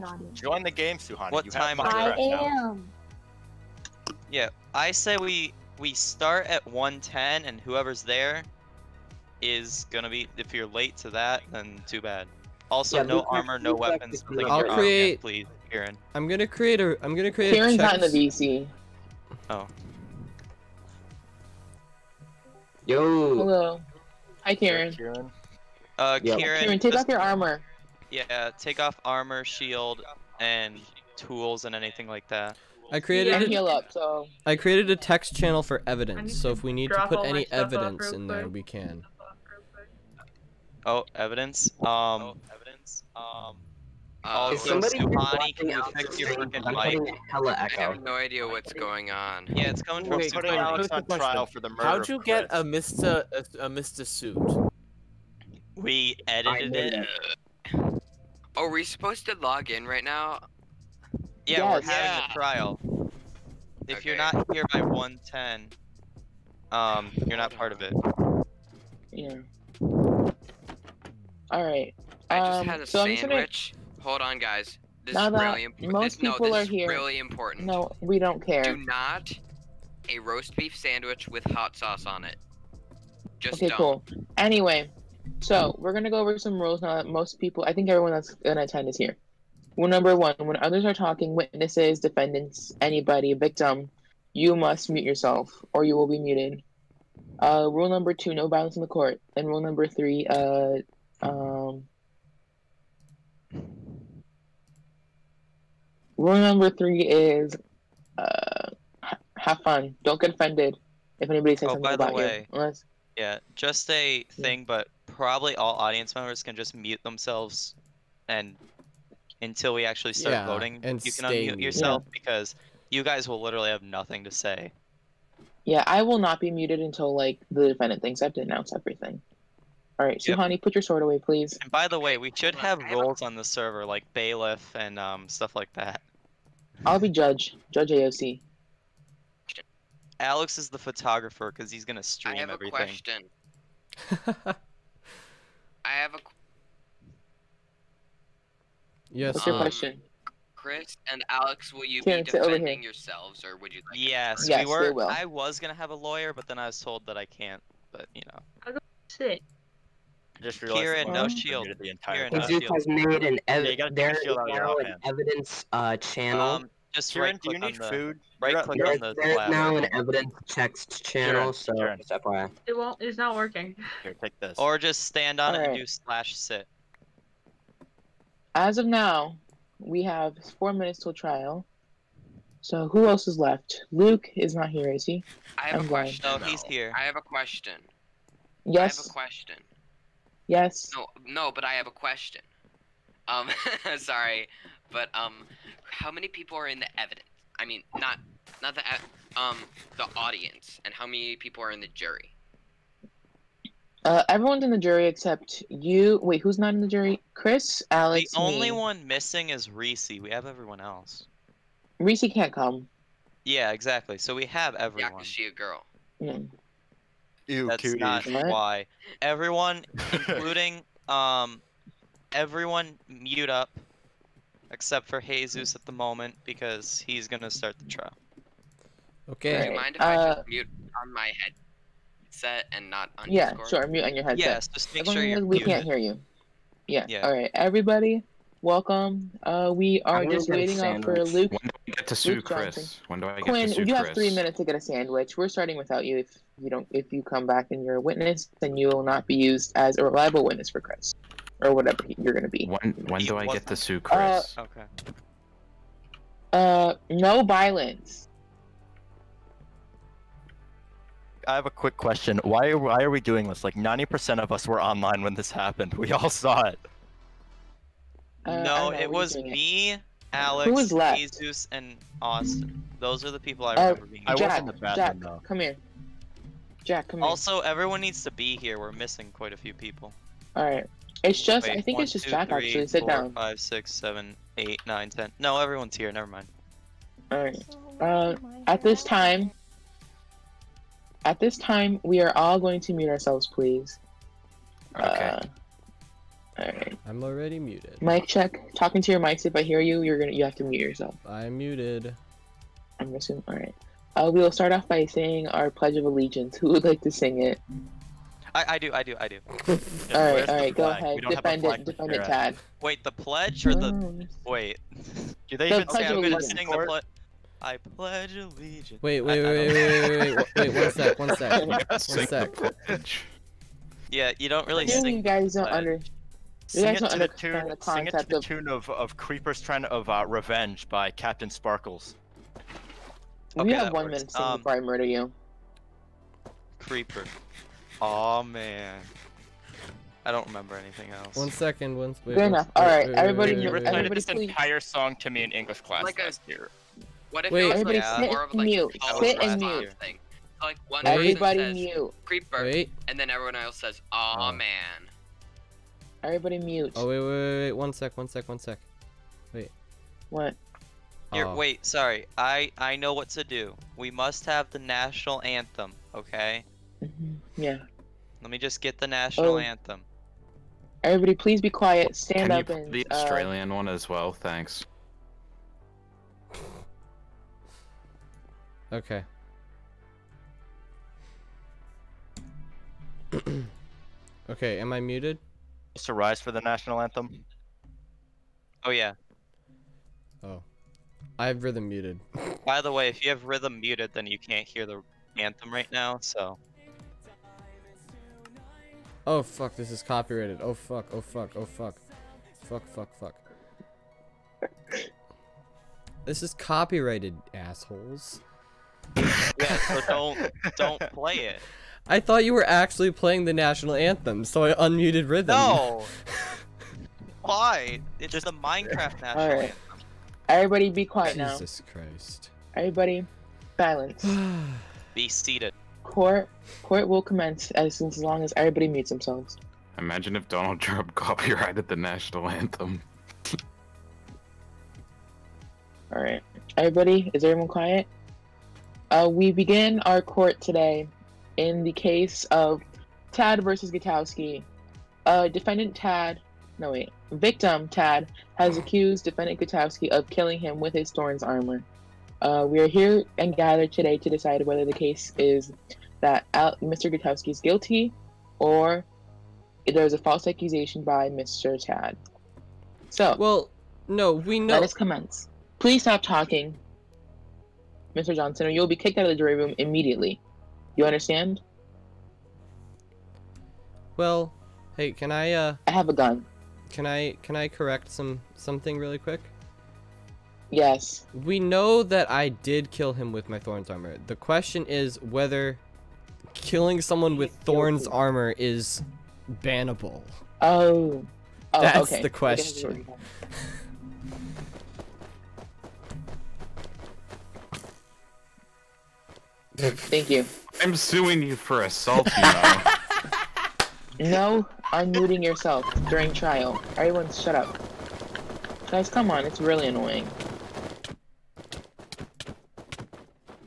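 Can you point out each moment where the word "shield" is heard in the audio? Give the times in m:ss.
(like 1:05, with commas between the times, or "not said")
0:29, 2:41.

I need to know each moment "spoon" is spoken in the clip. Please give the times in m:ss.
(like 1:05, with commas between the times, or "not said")
not said.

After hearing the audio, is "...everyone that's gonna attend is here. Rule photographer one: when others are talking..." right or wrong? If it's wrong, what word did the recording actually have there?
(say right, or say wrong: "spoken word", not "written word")
wrong: "number", not "photographer".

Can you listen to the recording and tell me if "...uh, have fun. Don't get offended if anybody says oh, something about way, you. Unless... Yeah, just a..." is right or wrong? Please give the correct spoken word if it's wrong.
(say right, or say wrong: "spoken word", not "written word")
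right.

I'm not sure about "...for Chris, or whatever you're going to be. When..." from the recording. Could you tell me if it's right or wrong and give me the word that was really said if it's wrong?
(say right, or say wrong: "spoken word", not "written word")
right.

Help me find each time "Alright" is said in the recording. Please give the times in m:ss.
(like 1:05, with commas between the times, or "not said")
4:56, 5:03, 5:42.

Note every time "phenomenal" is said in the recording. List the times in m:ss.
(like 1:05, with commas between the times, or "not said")
not said.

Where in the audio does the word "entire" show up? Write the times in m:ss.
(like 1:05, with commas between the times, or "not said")
2:41, 5:44.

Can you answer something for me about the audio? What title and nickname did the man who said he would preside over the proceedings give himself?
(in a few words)
Judge AOC.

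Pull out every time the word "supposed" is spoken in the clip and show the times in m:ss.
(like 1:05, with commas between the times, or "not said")
0:58.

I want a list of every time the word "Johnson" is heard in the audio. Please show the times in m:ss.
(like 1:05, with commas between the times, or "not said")
4:02, 7:48.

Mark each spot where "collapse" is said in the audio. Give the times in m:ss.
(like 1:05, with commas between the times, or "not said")
not said.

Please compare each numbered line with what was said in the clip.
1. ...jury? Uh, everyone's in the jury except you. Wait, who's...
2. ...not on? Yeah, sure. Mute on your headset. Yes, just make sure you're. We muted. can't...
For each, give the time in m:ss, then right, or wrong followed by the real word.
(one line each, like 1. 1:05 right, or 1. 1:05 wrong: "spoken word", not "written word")
1. 3:21 right
2. 3:52 right.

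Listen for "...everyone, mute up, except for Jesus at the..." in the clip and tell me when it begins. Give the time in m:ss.
3:42.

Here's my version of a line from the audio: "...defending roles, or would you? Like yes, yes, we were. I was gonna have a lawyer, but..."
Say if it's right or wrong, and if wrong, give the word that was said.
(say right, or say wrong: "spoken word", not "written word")
wrong: "yourselves", not "roles".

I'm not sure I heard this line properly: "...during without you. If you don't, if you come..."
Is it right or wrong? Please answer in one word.
wrong.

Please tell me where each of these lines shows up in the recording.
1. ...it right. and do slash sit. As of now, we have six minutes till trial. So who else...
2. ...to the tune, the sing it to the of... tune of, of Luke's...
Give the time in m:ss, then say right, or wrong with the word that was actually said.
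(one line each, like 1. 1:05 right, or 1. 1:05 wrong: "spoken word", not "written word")
1. 2:55 wrong: "four", not "six"
2. 5:27 wrong: "Creeper", not "Luke".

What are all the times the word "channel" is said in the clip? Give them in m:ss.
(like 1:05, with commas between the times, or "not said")
0:35, 2:45, 2:51.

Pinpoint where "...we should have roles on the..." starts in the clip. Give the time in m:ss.
2:12.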